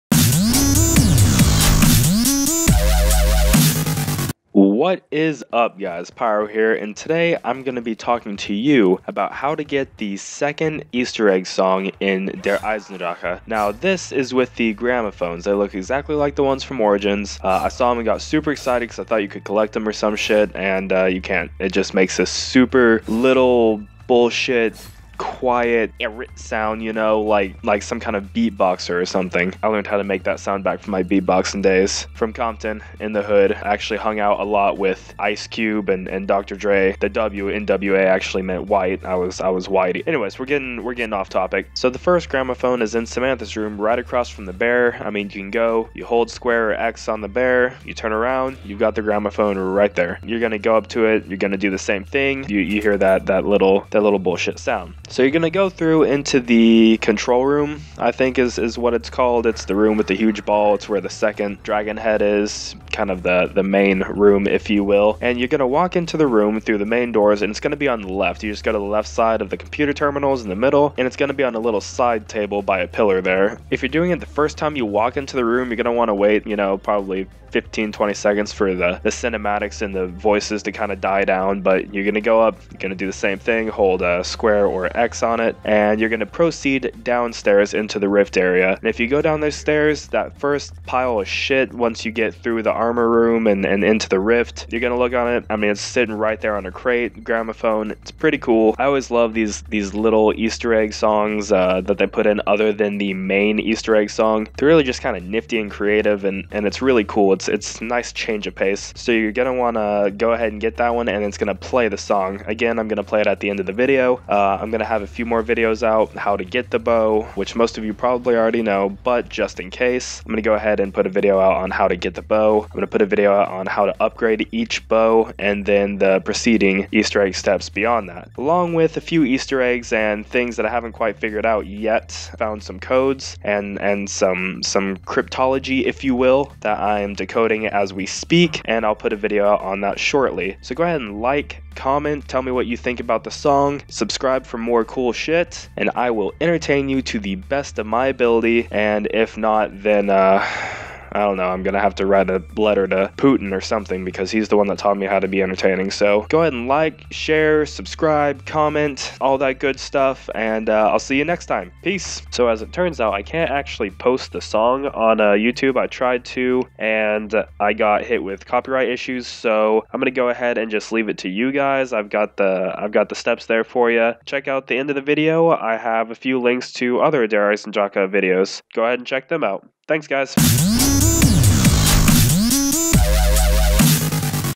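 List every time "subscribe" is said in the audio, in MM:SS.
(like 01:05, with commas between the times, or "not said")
02:23, 02:37.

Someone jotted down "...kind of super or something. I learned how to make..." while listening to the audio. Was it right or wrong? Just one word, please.
wrong.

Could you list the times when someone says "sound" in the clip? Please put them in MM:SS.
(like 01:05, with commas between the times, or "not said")
00:26, 00:30, 00:54.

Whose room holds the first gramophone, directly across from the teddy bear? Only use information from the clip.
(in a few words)
Samantha.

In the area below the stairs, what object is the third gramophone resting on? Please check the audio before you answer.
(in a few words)
a crate.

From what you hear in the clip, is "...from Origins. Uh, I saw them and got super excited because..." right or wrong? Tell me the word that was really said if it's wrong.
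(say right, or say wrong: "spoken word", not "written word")
right.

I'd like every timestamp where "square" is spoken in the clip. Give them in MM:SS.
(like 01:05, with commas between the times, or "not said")
00:46, 01:24.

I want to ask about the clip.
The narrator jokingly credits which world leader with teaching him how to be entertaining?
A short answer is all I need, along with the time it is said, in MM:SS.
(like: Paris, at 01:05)
Putin, at 02:33.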